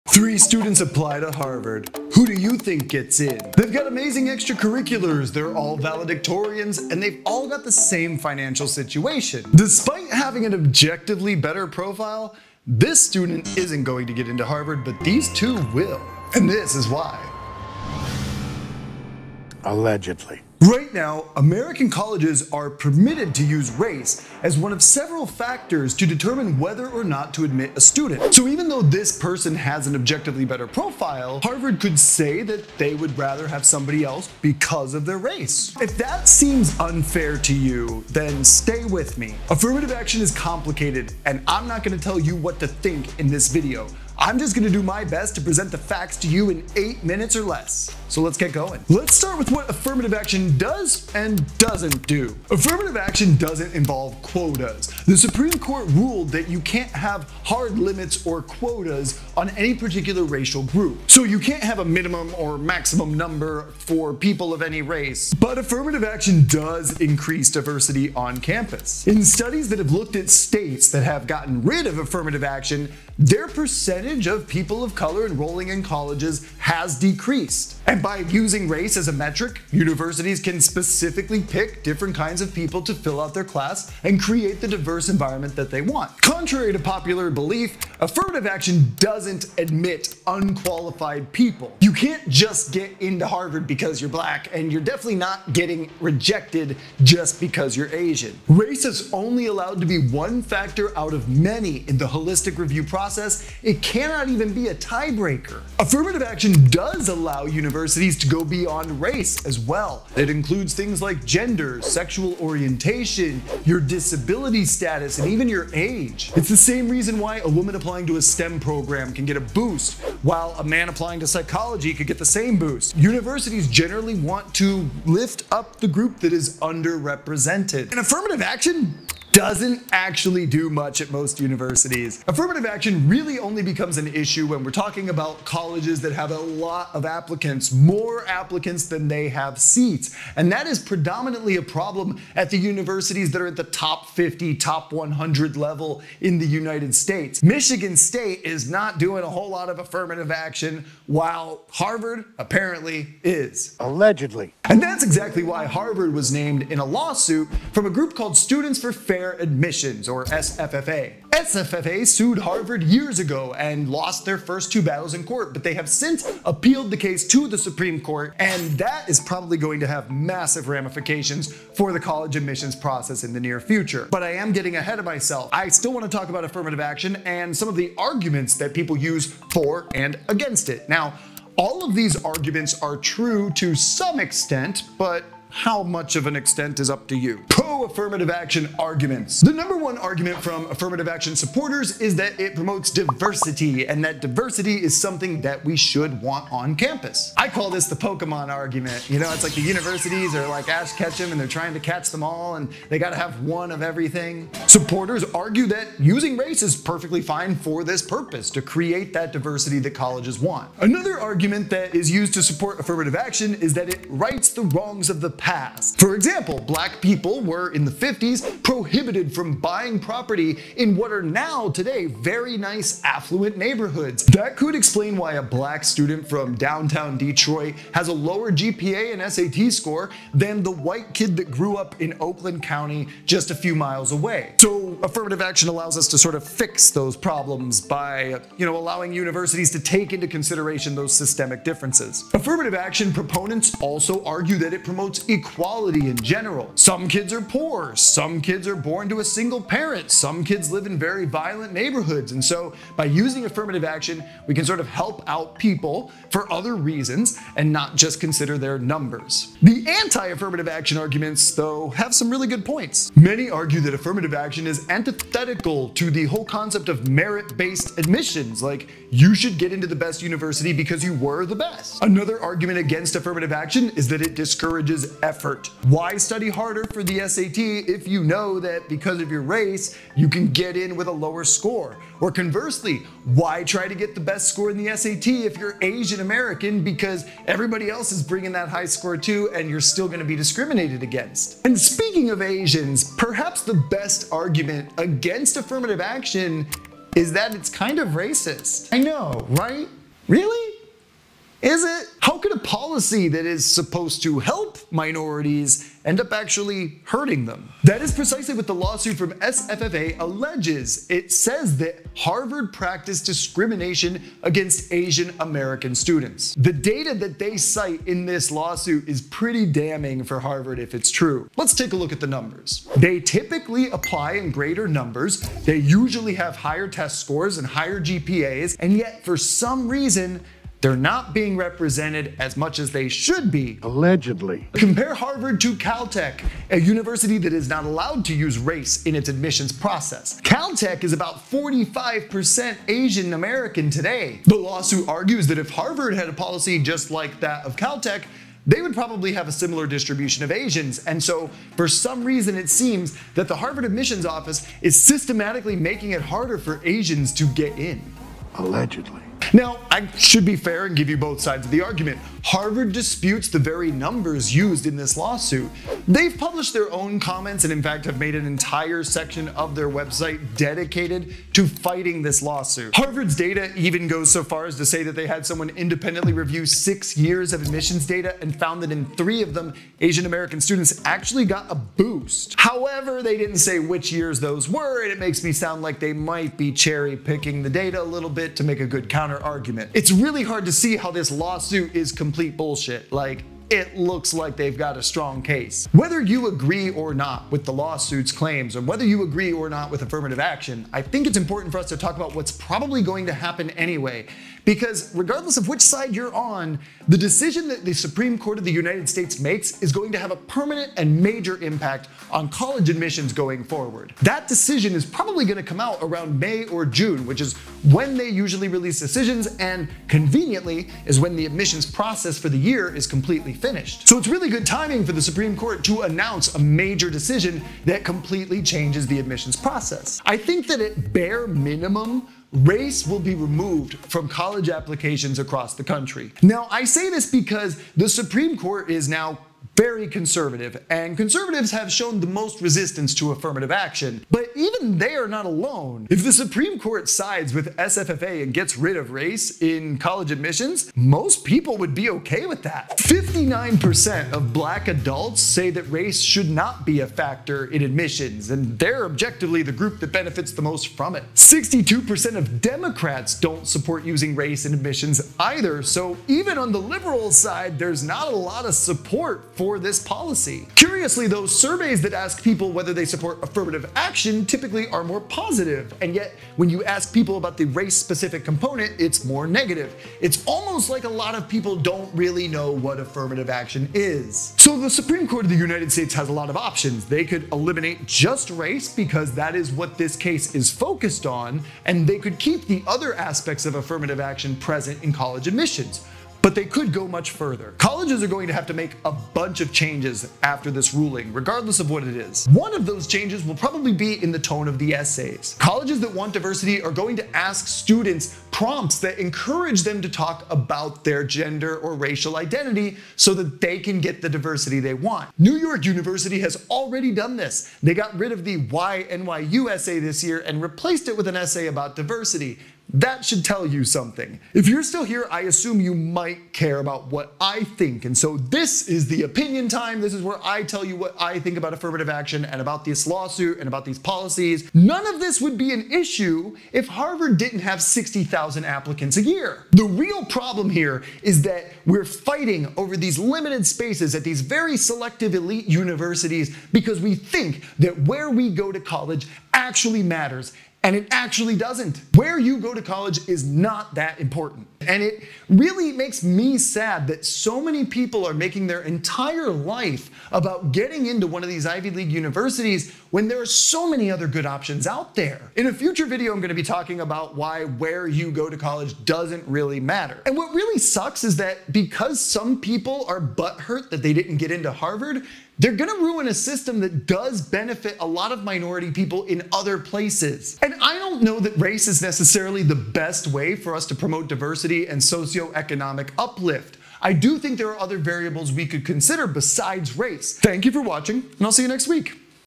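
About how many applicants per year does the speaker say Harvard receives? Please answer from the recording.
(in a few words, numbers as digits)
60,000.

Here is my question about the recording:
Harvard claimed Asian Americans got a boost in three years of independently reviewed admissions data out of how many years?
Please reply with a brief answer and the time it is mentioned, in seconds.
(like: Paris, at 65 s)
6, at 376 s.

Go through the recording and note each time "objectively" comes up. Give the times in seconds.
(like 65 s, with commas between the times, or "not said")
10 s, 29 s, 459 s.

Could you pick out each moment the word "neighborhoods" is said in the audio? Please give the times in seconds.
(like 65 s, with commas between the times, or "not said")
223 s, 251 s.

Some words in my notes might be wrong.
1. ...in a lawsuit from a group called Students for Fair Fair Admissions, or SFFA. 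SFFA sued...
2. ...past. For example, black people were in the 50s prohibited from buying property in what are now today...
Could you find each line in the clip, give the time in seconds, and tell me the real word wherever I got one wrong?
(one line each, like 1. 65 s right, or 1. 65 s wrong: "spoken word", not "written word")
1. 156 s right
2. 215 s right.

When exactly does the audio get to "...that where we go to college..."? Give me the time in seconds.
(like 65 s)
547 s.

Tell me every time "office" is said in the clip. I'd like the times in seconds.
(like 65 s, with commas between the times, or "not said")
354 s.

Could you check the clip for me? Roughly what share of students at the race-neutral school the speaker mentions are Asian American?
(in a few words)
45%.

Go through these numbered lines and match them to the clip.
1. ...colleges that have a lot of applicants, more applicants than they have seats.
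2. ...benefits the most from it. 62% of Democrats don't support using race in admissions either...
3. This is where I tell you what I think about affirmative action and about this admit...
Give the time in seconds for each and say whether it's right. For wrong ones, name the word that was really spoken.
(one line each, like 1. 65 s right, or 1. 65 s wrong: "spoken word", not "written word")
1. 135 s right
2. 460 s right
3. 530 s wrong: "lawsuit", not "admit".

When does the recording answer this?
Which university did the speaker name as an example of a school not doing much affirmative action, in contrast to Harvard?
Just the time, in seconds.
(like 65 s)
147 s.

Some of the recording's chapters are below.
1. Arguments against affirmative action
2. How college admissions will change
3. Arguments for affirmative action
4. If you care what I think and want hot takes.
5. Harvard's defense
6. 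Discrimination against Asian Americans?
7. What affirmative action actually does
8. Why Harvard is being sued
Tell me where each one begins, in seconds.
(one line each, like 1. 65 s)
1. 260 s
2. 396 s
3. 175 s
4. 524 s
5. 360 s
6. 302 s
7. 40 s
8. 131 s.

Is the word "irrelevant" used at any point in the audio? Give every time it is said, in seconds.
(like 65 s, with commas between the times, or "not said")
not said.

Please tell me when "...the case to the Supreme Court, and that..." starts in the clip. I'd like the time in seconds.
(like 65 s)
166 s.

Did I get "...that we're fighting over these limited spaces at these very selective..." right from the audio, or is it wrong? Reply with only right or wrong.
right.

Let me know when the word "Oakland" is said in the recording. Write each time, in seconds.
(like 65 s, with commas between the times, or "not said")
232 s.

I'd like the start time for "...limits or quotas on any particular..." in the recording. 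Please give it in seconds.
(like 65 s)
57 s.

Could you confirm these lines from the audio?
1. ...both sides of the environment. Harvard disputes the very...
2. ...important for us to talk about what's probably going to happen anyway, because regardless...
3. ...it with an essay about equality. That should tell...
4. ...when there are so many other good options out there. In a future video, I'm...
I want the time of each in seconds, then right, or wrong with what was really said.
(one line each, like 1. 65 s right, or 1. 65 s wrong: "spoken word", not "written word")
1. 361 s wrong: "argument", not "environment"
2. 401 s right
3. 521 s wrong: "diversity", not "equality"
4. 563 s right.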